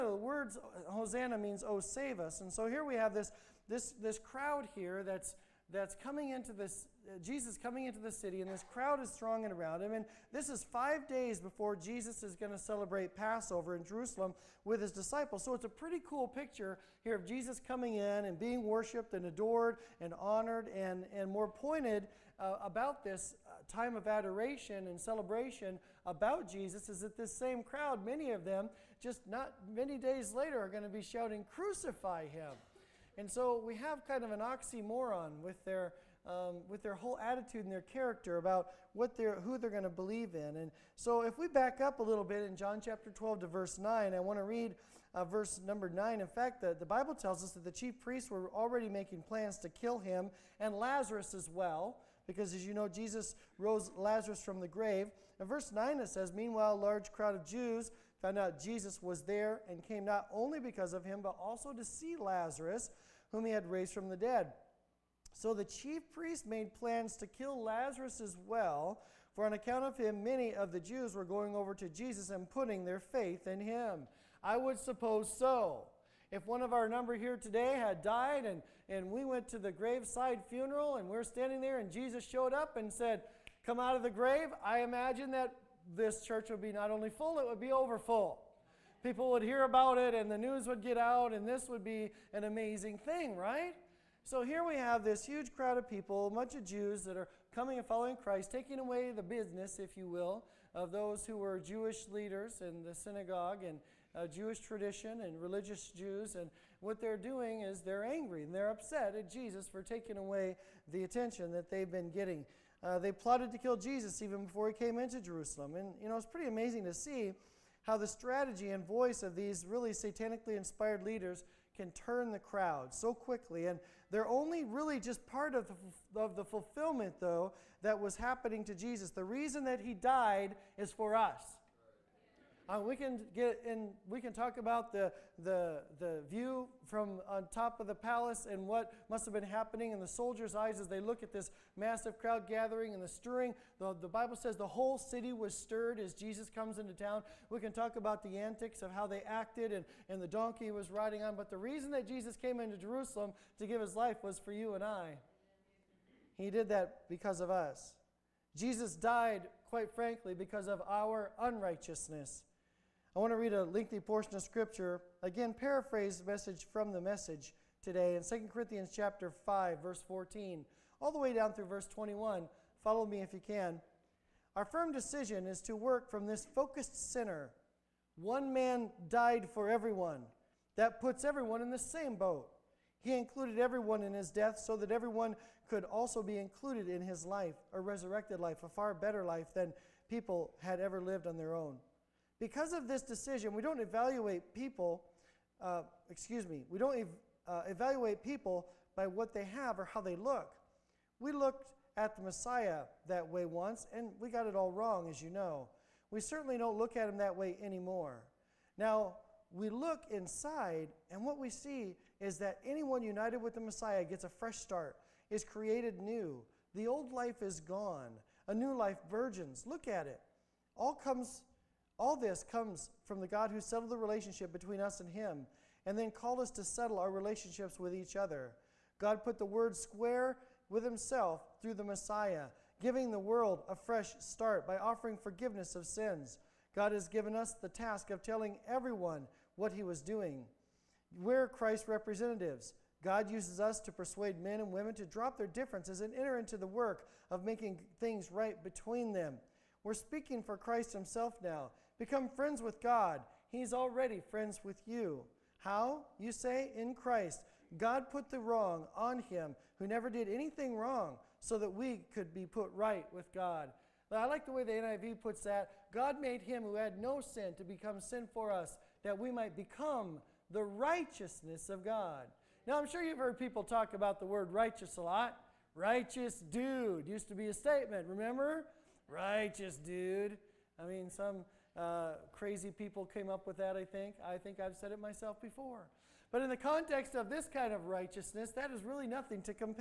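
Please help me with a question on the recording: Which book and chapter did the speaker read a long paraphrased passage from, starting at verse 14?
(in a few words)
2 Corinthians 5.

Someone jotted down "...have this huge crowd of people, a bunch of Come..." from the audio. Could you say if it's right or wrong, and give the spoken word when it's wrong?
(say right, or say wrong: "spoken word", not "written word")
wrong: "Jews", not "Come".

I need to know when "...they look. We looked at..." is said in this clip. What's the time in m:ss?
3:20.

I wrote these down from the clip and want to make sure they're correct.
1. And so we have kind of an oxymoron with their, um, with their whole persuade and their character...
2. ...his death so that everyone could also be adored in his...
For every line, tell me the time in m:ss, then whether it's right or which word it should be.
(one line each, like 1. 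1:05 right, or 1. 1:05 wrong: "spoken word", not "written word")
1. 0:33 wrong: "attitude", not "persuade"
2. 3:04 wrong: "included", not "adored".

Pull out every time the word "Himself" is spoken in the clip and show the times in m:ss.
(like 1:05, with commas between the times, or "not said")
3:50, 4:10.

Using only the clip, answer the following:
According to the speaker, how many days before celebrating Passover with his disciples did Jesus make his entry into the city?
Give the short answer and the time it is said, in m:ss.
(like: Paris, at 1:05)
5, at 0:10.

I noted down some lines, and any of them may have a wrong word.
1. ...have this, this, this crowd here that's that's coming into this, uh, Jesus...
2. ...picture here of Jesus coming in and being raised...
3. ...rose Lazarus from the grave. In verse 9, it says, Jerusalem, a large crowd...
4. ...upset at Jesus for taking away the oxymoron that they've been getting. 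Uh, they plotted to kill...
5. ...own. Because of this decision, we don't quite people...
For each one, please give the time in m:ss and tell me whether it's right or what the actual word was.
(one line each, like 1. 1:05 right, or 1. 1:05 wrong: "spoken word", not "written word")
1. 0:02 right
2. 0:16 wrong: "worshiped", not "raised"
3. 0:53 wrong: "Meanwhile", not "Jerusalem"
4. 1:48 wrong: "attention", not "oxymoron"
5. 3:11 wrong: "evaluate", not "quite".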